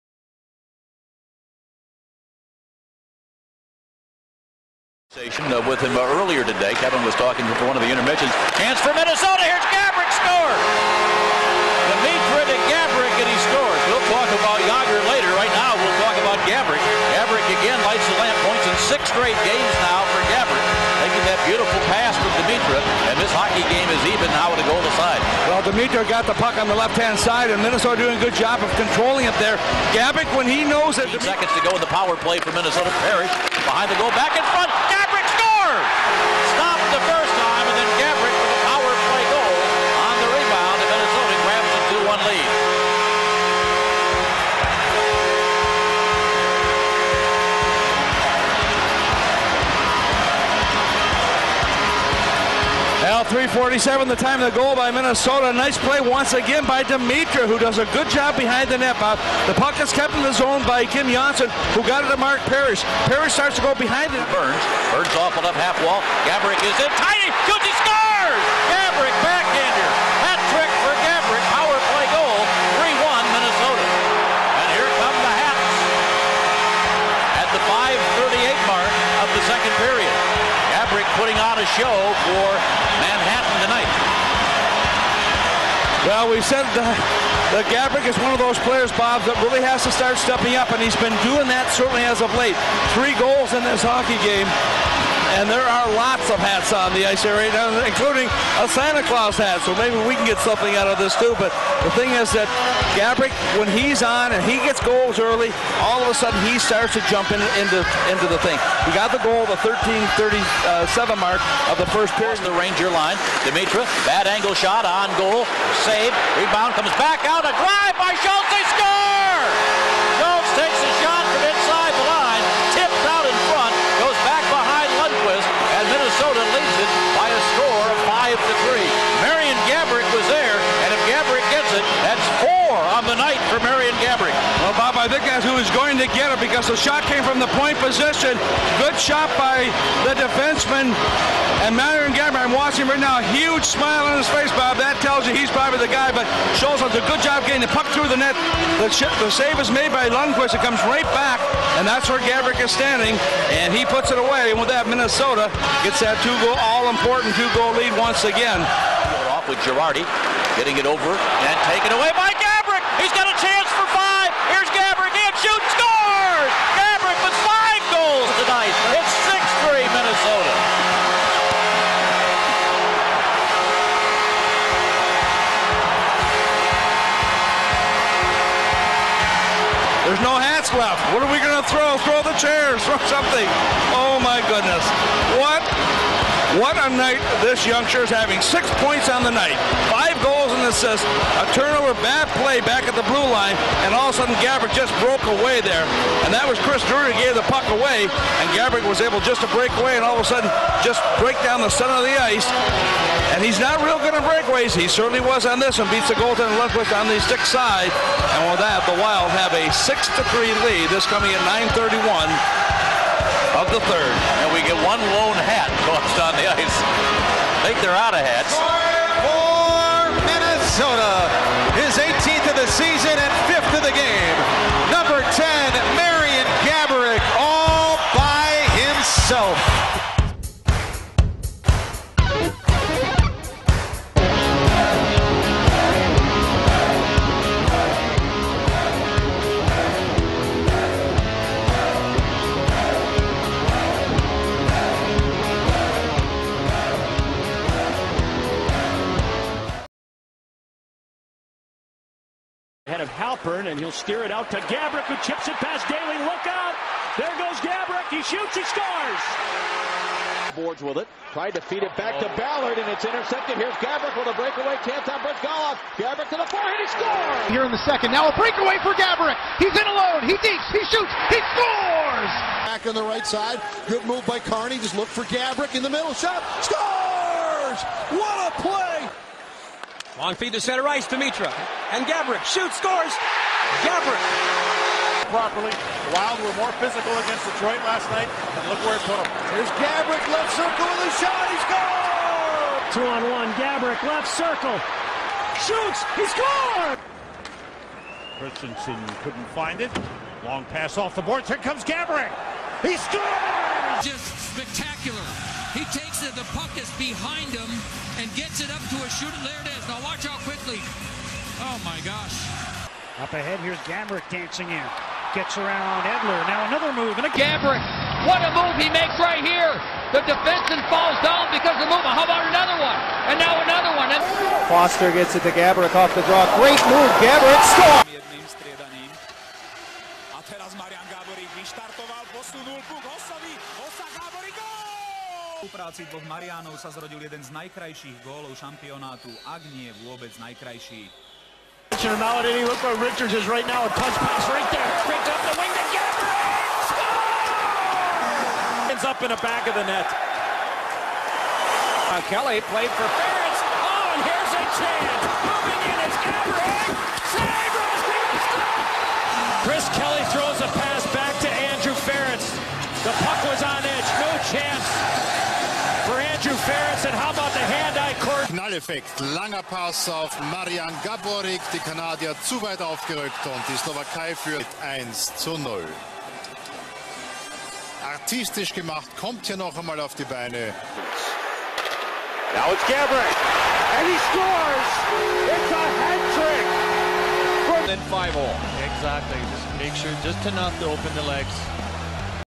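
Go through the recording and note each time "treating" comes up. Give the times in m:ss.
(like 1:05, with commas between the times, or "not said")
not said.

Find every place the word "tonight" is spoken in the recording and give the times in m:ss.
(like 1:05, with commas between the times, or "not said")
1:23.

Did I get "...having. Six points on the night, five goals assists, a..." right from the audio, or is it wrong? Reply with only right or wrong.
right.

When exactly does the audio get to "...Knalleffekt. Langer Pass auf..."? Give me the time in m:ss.
6:08.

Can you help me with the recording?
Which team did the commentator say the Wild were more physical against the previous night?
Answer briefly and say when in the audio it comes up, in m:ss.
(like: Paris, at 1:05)
Detroit, at 4:47.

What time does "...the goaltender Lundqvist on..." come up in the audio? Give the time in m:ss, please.
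3:26.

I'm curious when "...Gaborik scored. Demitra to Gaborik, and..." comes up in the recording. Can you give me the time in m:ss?
0:09.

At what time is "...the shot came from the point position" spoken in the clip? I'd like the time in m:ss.
2:16.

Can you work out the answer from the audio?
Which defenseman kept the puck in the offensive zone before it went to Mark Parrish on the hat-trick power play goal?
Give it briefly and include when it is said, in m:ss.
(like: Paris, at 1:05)
Kim Johnsson, at 1:00.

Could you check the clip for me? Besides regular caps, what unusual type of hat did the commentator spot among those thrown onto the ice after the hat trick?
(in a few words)
Santa Claus hat.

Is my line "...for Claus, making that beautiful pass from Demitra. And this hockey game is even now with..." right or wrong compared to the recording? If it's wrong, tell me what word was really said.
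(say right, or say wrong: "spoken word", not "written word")
wrong: "Gaborik", not "Claus".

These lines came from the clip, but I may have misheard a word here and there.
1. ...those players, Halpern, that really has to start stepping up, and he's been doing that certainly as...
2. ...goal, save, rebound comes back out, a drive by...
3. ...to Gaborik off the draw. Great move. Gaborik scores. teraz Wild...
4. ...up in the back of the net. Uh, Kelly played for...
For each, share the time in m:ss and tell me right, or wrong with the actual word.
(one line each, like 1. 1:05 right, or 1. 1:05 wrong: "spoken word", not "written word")
1. 1:28 wrong: "Bob", not "Halpern"
2. 1:55 right
3. 5:25 wrong: "Marian", not "Wild"
4. 5:49 right.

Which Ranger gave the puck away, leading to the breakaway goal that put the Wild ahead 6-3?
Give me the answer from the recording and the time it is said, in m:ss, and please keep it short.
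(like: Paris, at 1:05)
Chris Drury, at 3:16.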